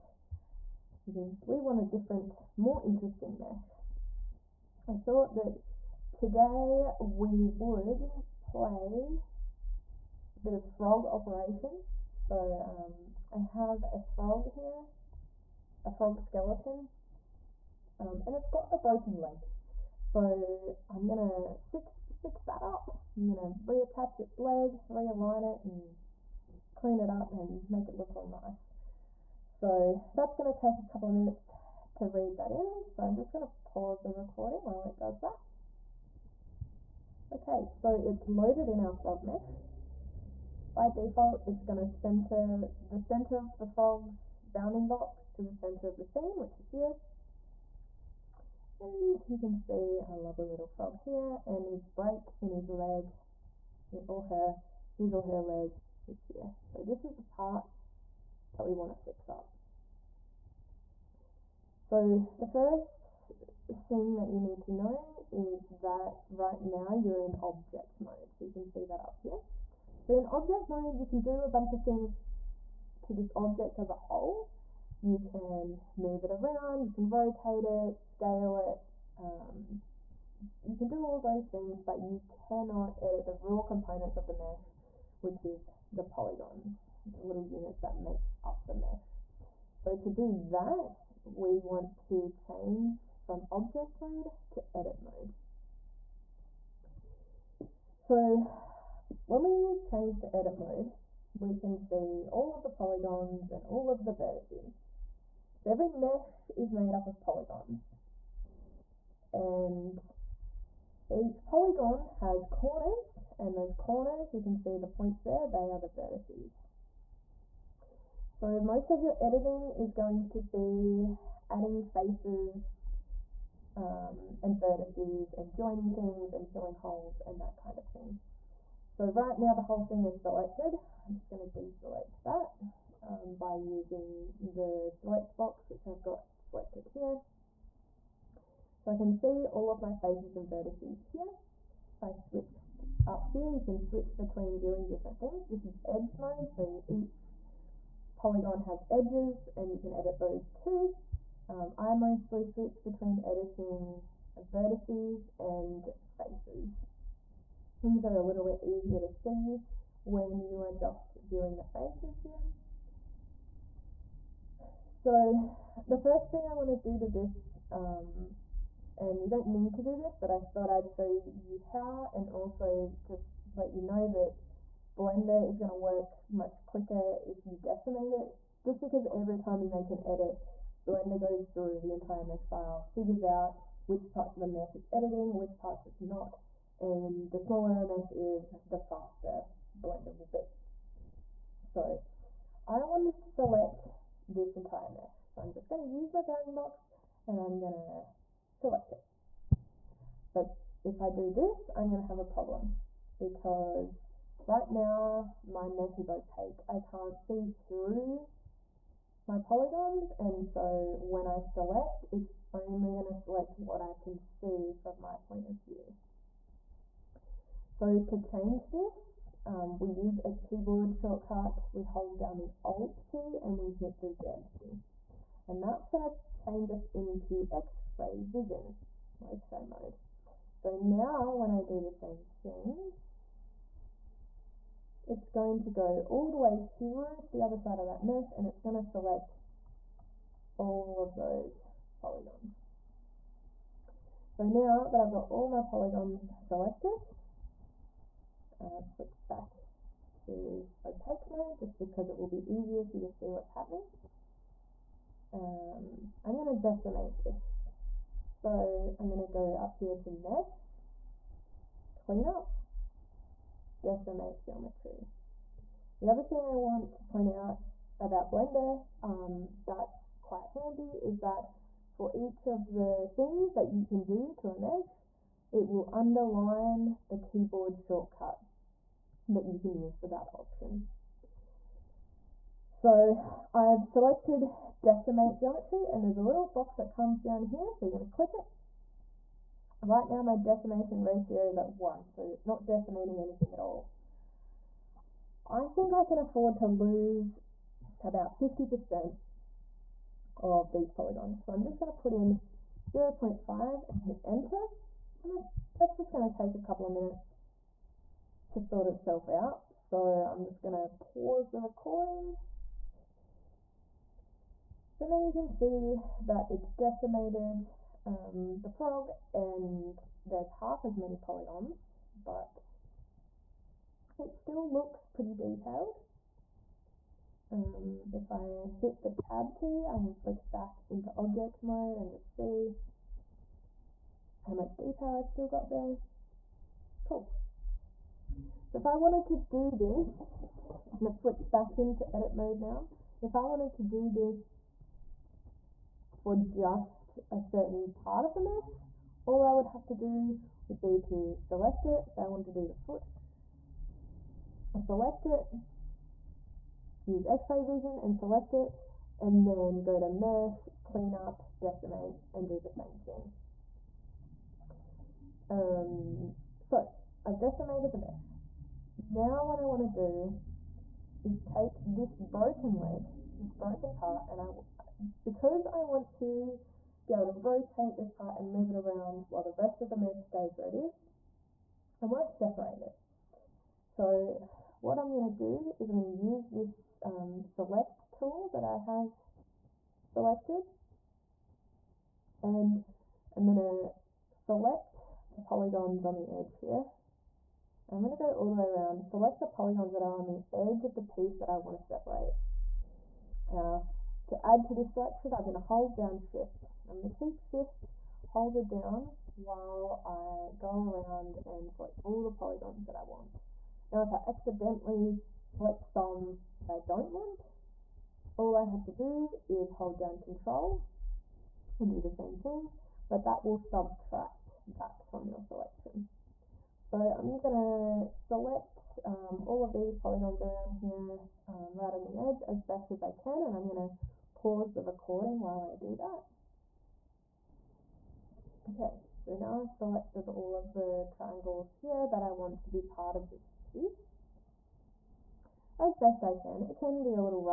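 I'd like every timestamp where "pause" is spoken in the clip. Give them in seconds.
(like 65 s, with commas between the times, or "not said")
33 s, 311 s, 434 s.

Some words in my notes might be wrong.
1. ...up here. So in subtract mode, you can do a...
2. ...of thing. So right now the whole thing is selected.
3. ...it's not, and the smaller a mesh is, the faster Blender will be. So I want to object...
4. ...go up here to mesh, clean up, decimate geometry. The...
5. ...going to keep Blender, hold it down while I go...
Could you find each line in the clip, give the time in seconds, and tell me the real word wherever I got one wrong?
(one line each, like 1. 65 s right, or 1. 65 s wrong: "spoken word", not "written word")
1. 69 s wrong: "object", not "subtract"
2. 127 s right
3. 185 s wrong: "select", not "object"
4. 259 s right
5. 406 s wrong: "Shift", not "Blender".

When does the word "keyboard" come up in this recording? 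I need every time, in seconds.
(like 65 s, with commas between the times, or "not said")
220 s, 277 s.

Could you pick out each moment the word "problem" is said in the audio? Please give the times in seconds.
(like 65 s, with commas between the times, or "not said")
202 s.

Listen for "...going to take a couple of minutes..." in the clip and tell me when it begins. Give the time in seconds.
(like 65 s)
306 s.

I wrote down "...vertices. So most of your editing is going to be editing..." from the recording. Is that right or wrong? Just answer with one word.
wrong.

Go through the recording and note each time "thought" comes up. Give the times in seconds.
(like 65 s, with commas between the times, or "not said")
4 s, 170 s.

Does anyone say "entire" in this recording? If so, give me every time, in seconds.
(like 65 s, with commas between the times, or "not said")
181 s, 194 s.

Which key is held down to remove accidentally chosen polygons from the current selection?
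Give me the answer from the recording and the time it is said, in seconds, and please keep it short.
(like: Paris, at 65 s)
Control, at 420 s.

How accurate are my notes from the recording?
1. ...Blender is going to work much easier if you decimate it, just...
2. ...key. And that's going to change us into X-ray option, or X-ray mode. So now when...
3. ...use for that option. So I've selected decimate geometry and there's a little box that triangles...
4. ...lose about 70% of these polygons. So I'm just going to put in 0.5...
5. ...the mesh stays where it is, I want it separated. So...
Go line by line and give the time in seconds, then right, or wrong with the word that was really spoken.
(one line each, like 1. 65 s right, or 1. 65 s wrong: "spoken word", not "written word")
1. 175 s wrong: "quicker", not "easier"
2. 224 s wrong: "vision", not "option"
3. 279 s wrong: "comes", not "triangles"
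4. 296 s wrong: "50", not "70"
5. 379 s right.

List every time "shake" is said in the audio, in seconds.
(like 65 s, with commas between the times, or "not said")
not said.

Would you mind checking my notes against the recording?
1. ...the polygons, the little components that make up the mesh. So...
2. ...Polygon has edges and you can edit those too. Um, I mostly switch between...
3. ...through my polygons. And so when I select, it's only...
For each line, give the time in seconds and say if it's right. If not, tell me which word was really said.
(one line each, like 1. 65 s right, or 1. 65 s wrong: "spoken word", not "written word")
1. 85 s wrong: "units", not "components"
2. 148 s right
3. 207 s right.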